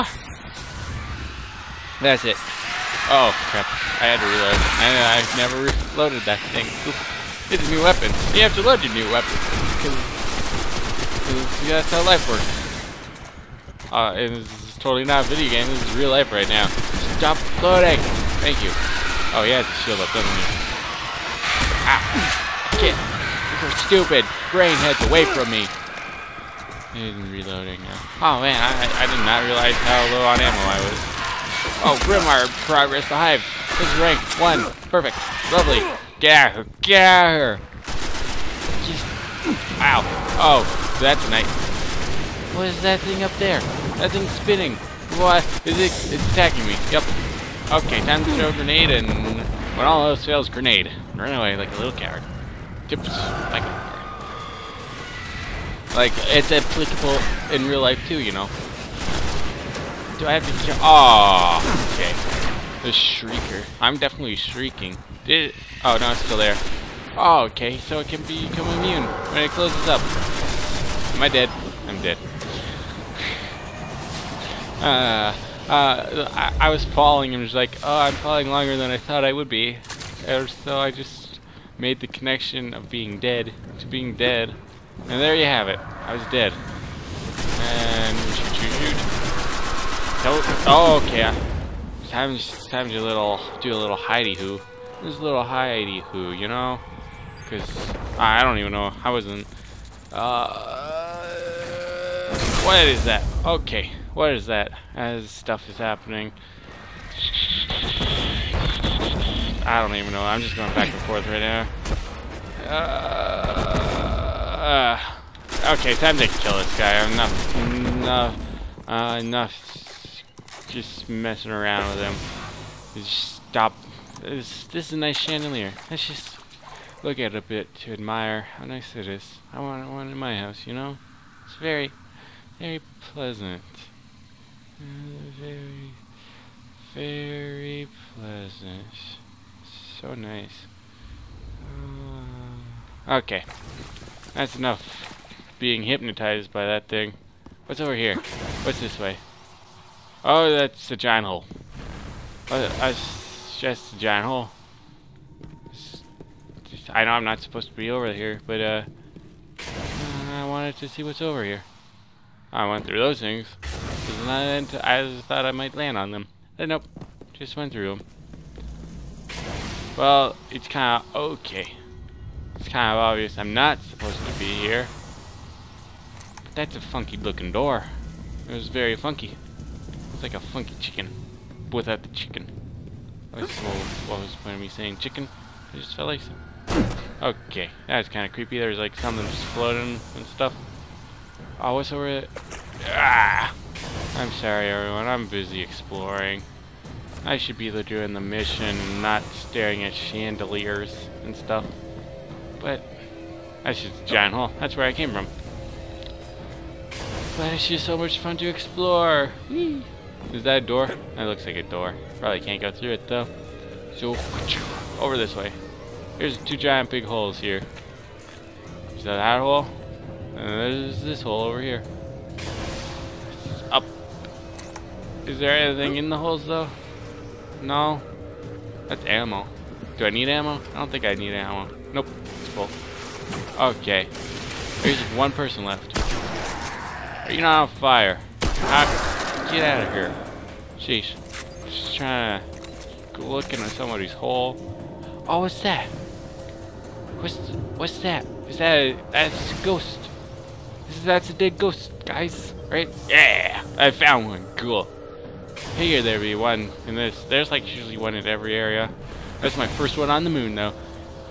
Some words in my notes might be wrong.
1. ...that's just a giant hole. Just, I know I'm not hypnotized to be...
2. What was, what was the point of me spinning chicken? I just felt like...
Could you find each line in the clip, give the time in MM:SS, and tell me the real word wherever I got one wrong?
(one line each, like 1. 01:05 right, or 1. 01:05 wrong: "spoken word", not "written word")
1. 02:32 wrong: "supposed", not "hypnotized"
2. 03:03 wrong: "saying", not "spinning".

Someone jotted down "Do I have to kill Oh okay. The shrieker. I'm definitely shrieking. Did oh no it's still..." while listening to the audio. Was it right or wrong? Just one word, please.
right.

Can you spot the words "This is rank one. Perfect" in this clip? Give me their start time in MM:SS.
00:33.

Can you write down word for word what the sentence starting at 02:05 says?
Let's just look at it a bit to admire how nice it is.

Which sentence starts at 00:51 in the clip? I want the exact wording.
Run away like a little coward.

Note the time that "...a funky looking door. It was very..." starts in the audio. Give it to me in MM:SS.
02:56.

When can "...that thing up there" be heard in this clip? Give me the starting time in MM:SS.
00:42.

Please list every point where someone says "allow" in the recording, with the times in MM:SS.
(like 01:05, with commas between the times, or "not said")
not said.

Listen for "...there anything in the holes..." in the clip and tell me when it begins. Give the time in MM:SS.
03:45.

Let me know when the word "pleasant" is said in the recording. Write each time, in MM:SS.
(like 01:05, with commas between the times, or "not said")
02:13, 02:18.